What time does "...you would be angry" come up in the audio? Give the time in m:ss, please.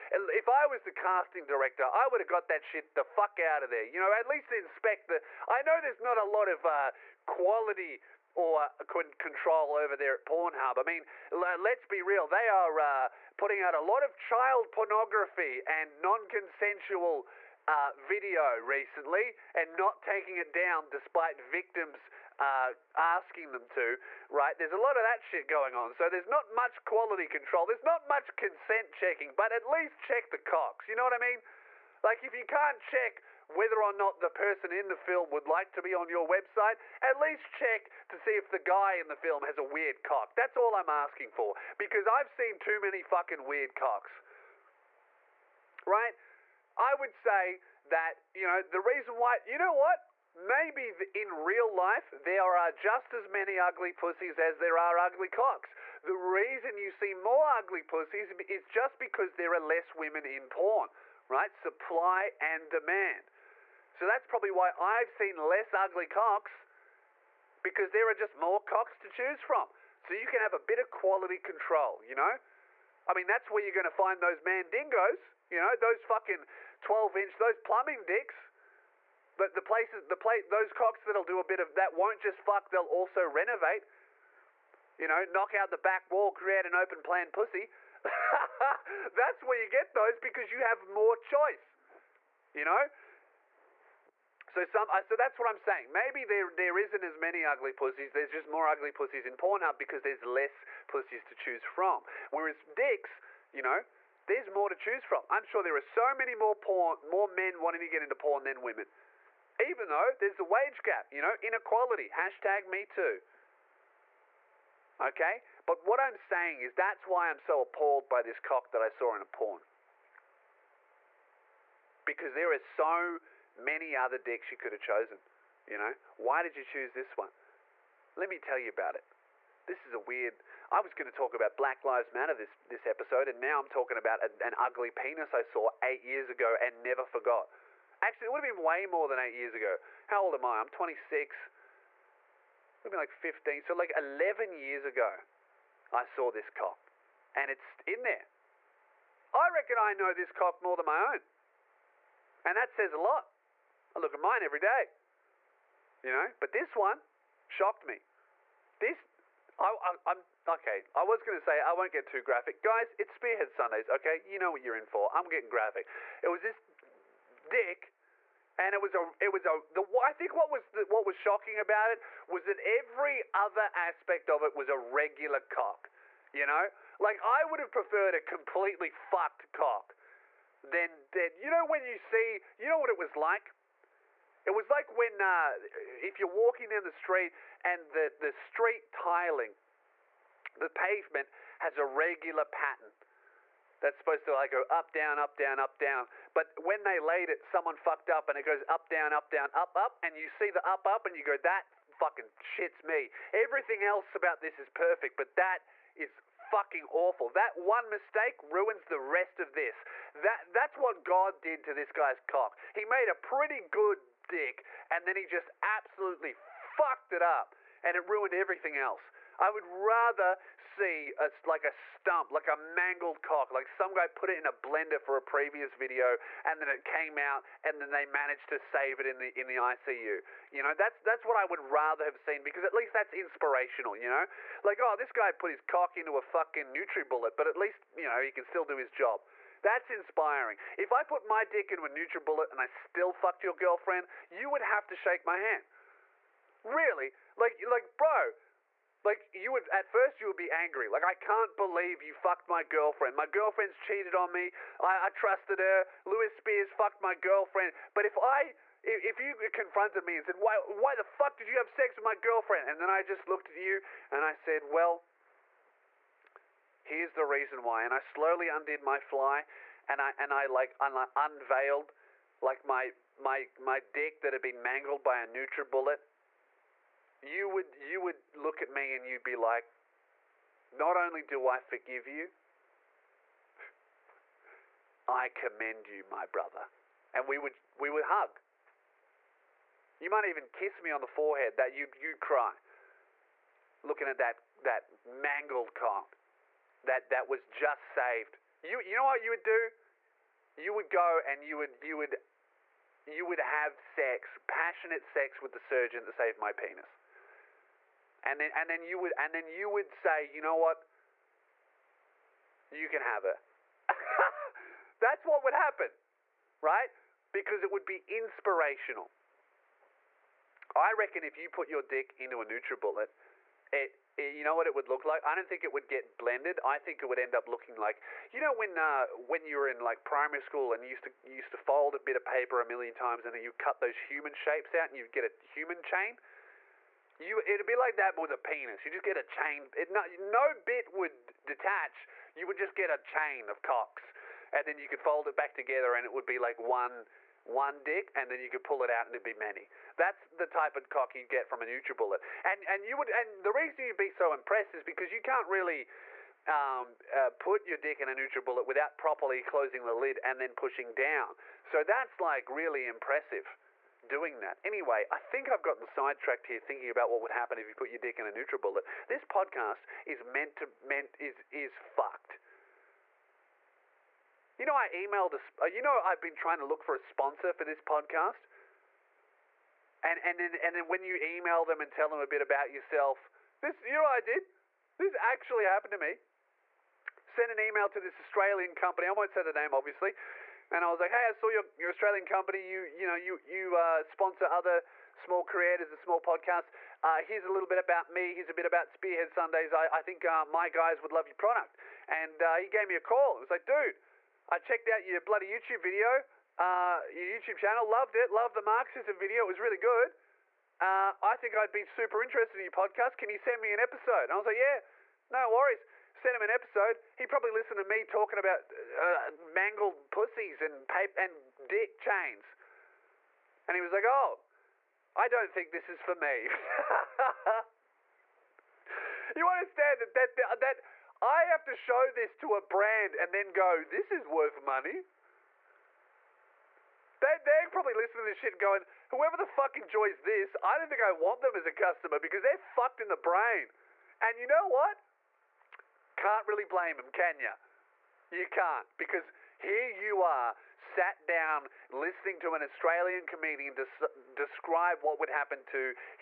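4:10.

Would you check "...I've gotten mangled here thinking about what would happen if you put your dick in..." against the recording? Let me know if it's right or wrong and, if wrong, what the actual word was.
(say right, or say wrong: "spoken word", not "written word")
wrong: "sidetracked", not "mangled".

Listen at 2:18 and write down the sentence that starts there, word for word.
Actually, it would have been way more than eight years ago.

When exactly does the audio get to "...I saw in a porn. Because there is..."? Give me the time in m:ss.
1:58.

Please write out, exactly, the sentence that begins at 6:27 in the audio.
Sent an email to this Australian company.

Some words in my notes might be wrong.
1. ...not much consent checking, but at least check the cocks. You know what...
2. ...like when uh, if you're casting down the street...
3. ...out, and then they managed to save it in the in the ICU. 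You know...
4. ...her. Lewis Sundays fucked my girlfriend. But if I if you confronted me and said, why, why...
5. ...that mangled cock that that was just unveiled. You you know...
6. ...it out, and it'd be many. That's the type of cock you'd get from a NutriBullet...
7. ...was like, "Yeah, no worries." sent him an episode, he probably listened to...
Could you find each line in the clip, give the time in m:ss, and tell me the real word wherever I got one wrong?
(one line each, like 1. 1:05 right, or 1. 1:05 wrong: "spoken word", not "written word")
1. 0:27 right
2. 3:04 wrong: "walking", not "casting"
3. 3:47 right
4. 4:15 wrong: "Spears", not "Sundays"
5. 4:54 wrong: "saved", not "unveiled"
6. 5:48 right
7. 6:54 right.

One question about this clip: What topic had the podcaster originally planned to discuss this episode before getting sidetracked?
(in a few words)
Black Lives Matter.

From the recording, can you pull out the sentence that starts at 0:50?
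Maybe in real life, there are just as many ugly pussies as there are ugly cocks.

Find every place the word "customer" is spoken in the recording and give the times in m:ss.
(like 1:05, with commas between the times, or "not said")
7:21.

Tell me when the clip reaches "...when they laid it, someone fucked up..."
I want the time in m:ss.
3:16.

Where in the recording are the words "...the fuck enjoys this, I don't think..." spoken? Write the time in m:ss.
7:19.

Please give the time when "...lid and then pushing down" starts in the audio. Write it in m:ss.
5:59.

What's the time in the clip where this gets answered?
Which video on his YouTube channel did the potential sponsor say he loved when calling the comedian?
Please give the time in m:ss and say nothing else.
6:48.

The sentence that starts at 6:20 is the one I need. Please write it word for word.
And and then and then when you email them and tell them a bit about yourself, this you know what I did.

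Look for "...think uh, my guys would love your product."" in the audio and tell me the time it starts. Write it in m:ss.
6:40.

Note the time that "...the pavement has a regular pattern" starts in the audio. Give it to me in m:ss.
3:10.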